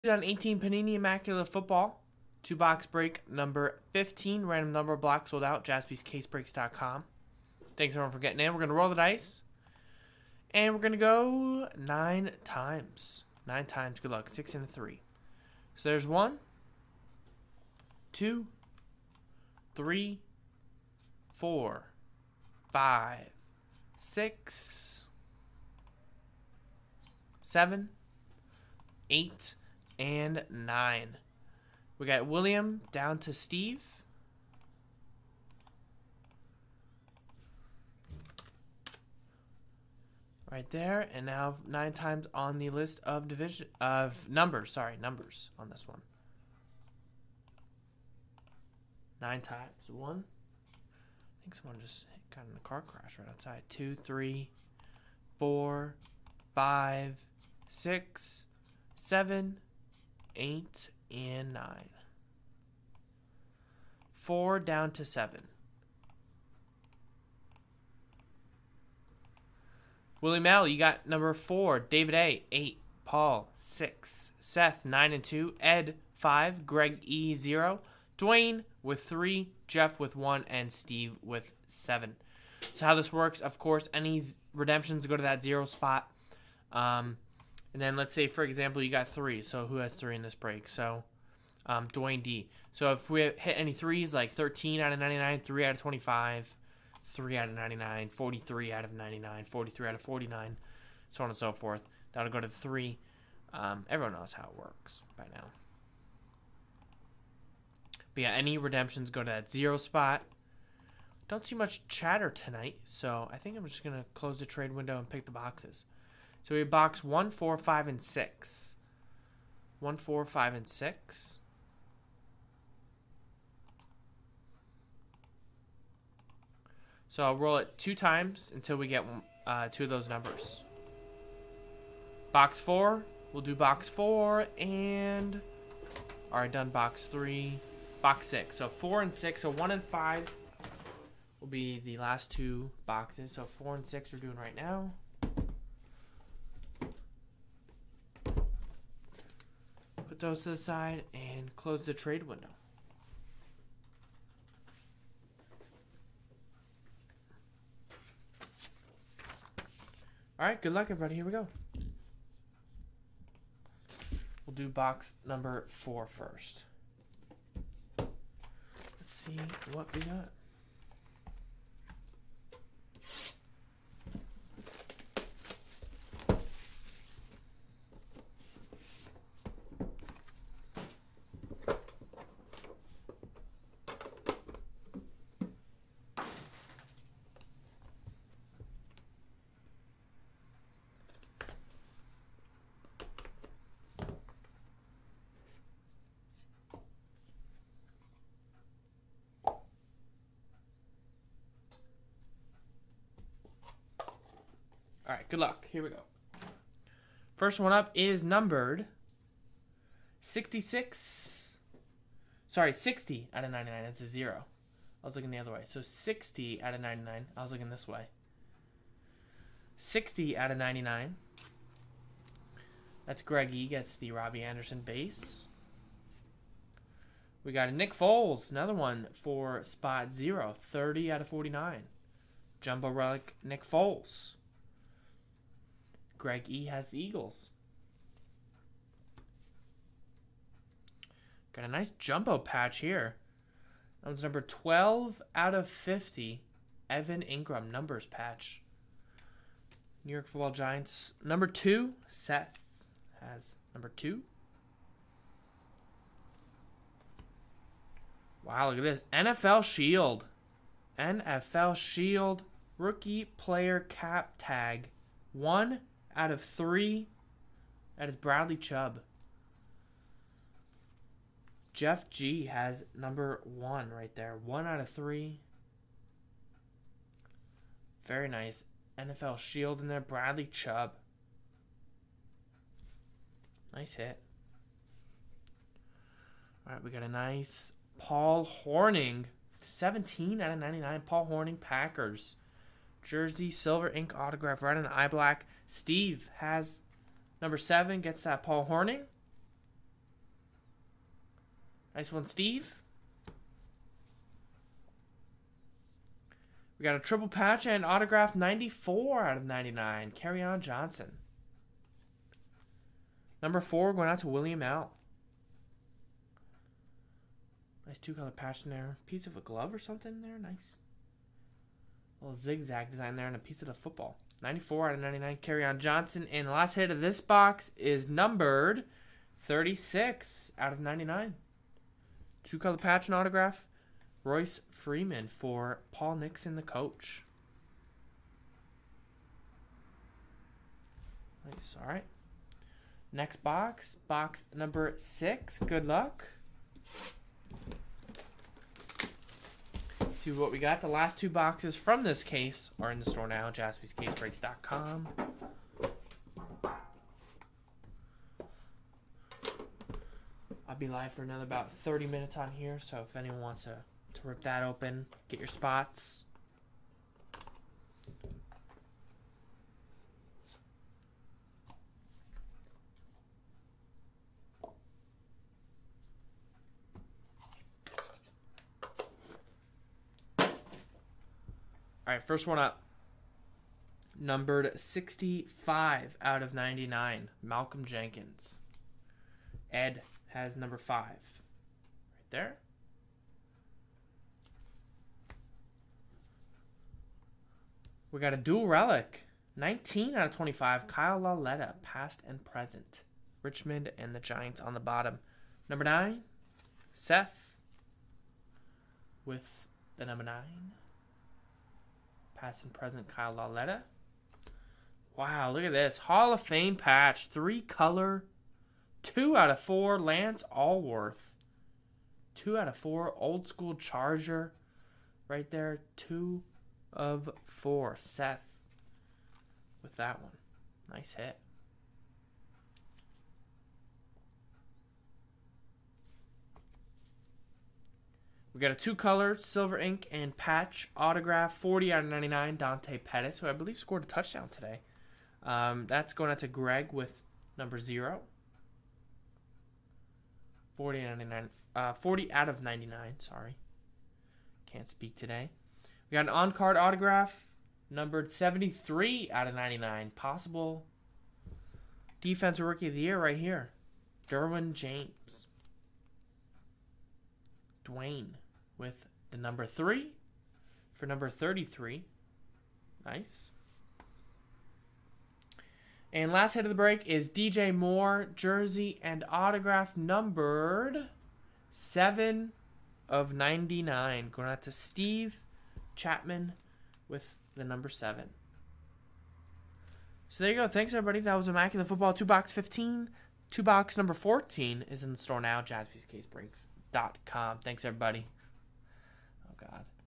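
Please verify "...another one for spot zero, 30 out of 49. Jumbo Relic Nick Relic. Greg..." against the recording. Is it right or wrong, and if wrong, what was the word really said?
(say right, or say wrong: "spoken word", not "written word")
wrong: "Foles", not "Relic".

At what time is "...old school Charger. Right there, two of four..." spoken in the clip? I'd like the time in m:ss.
7:03.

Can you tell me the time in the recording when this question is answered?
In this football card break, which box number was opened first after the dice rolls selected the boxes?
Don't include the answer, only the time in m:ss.
2:44.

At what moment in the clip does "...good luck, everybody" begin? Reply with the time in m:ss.
2:40.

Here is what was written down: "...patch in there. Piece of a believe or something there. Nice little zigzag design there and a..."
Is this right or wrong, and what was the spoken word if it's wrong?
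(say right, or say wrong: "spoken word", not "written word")
wrong: "glove", not "believe".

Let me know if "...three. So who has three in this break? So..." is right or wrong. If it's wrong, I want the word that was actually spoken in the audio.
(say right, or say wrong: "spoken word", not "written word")
right.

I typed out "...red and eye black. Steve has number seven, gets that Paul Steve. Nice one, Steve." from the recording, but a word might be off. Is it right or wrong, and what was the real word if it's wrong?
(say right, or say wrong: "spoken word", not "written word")
wrong: "Hornung", not "Steve".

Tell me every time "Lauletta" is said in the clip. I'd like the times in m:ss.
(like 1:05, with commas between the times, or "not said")
6:41, 6:53.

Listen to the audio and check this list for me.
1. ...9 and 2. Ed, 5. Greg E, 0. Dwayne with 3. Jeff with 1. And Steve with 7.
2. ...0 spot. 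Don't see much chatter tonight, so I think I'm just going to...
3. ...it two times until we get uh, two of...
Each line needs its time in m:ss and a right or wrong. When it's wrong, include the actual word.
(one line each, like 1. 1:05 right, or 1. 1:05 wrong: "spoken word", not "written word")
1. 1:14 right
2. 1:49 right
3. 2:07 right.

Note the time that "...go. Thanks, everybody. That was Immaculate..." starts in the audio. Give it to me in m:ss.
8:10.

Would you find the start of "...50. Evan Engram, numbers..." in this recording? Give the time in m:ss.
4:05.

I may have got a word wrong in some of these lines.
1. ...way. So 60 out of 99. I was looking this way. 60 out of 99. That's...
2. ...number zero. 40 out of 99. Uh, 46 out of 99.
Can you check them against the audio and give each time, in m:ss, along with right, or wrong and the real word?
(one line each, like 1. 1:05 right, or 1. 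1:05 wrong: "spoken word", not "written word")
1. 3:35 right
2. 7:27 wrong: "40", not "46".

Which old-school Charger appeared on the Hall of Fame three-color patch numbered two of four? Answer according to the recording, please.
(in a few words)
Lance Alworth.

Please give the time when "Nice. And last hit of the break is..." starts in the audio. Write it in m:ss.
7:53.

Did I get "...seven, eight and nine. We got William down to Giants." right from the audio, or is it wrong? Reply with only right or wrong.
wrong.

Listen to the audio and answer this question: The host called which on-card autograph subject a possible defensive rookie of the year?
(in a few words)
Derwin James.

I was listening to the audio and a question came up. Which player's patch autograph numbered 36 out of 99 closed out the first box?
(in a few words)
Royce Freeman.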